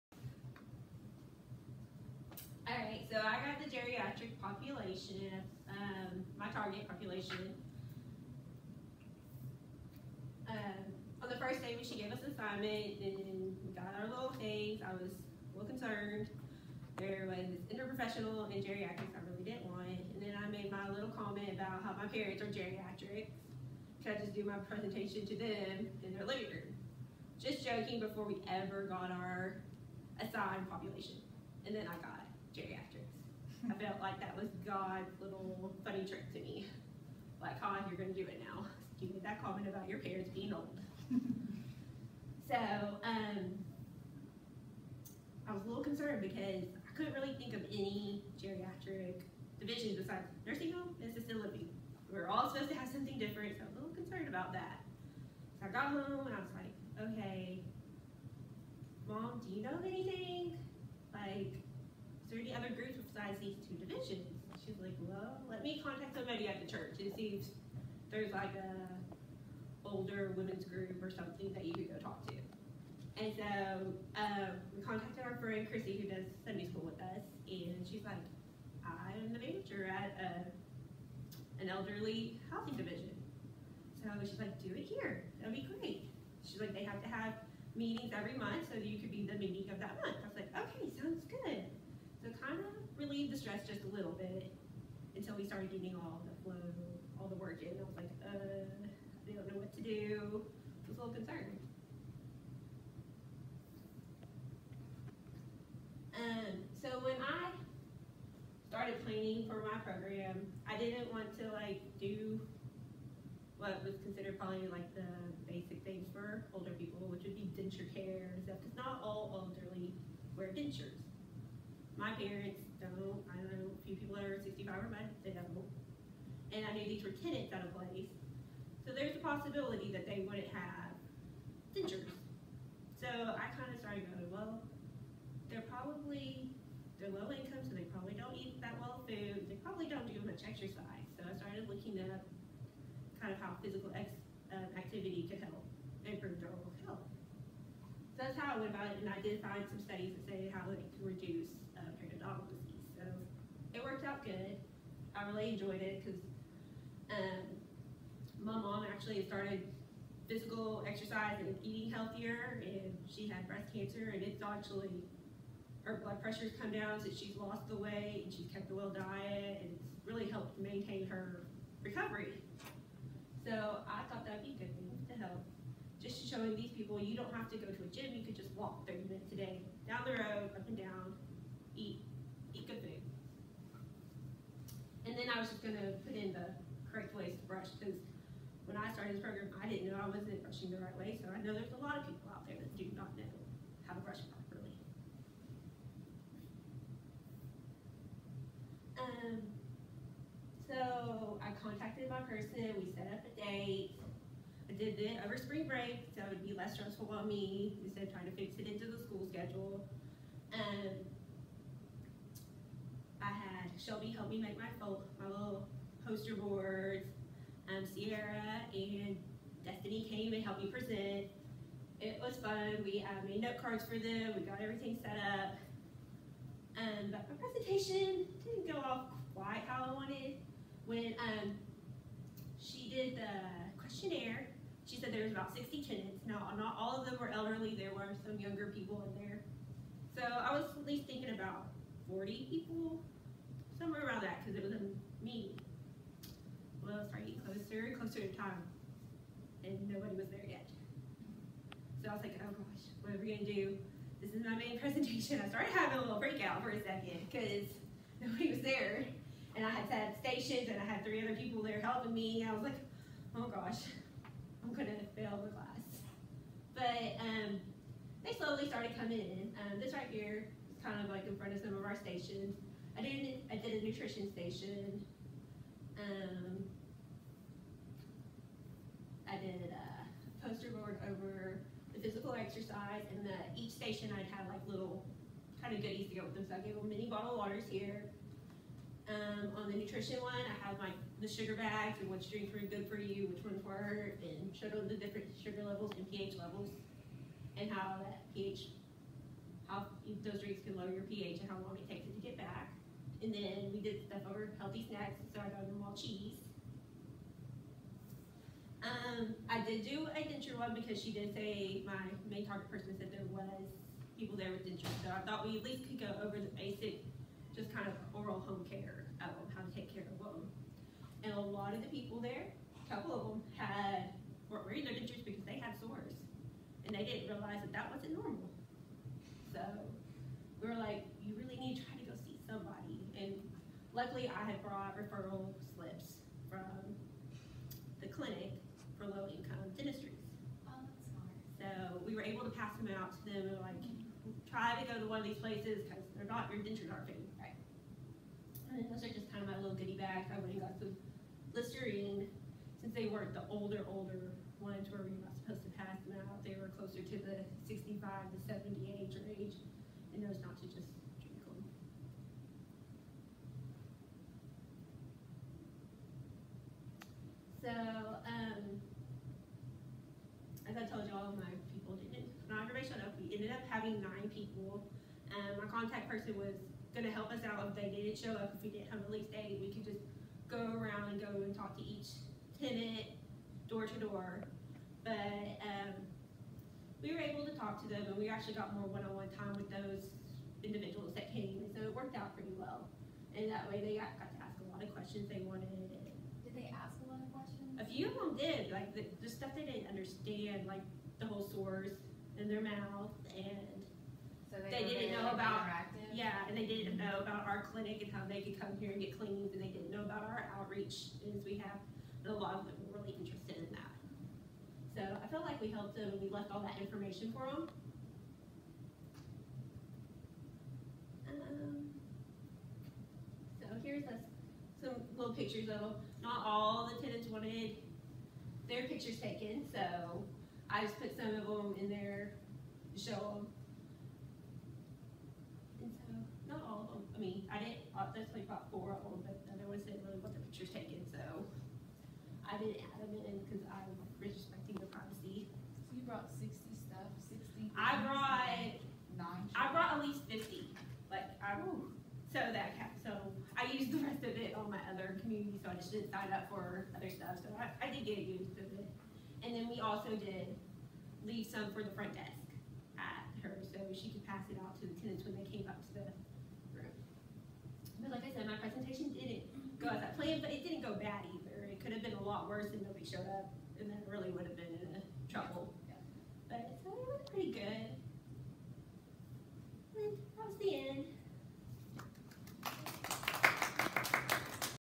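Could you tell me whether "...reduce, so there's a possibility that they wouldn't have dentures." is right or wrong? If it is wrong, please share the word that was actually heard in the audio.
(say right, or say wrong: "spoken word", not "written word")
wrong: "place", not "reduce".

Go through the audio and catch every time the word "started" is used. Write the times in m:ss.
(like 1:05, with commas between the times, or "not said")
1:35, 1:48, 2:13, 2:21, 2:39, 3:08, 4:15, 4:28.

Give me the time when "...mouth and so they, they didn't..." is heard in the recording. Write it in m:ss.
6:42.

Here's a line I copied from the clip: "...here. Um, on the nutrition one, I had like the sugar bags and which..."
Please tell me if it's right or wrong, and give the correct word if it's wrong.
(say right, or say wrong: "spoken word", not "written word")
right.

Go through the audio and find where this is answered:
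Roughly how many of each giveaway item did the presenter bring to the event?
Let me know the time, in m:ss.
7:30.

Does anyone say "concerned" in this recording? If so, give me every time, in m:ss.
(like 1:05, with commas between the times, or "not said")
0:15, 0:45, 0:53, 1:41.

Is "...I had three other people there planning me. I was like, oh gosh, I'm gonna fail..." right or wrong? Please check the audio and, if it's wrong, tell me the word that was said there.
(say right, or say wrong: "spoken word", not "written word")
wrong: "helping", not "planning".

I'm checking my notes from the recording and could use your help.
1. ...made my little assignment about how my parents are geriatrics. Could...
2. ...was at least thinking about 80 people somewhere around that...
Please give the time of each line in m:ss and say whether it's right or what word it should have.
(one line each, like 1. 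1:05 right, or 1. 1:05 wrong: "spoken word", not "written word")
1. 0:20 wrong: "comment", not "assignment"
2. 4:00 wrong: "40", not "80".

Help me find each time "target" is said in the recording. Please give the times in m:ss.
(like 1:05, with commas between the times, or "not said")
0:06, 5:12.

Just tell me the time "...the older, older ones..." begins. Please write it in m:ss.
5:53.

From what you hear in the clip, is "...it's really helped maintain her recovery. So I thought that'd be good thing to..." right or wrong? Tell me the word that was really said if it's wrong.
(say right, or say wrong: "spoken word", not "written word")
right.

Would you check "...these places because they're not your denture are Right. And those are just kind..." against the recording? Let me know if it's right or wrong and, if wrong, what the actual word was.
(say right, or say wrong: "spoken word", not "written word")
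right.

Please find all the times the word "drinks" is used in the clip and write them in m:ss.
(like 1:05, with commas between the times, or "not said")
4:52, 5:00.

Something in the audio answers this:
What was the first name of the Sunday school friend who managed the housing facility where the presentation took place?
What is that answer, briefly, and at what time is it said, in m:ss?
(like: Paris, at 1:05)
Chrissy, at 1:15.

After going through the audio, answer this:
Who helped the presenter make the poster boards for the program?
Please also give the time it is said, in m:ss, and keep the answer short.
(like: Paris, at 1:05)
Shelby, at 3:33.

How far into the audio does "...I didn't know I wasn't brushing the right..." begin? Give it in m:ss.
3:09.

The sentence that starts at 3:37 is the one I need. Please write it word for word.
Um, Sierra and Destiny came and helped me present.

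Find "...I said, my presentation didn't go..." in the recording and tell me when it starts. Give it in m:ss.
7:48.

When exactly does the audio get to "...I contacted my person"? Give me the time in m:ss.
3:21.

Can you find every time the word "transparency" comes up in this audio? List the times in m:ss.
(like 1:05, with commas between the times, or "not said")
not said.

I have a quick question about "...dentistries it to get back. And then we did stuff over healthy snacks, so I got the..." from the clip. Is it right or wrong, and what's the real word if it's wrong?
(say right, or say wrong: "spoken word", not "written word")
wrong: "takes", not "dentistries".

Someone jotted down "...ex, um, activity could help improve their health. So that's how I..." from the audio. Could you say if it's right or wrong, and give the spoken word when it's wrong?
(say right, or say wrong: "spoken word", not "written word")
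right.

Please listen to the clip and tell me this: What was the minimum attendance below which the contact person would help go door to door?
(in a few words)
8.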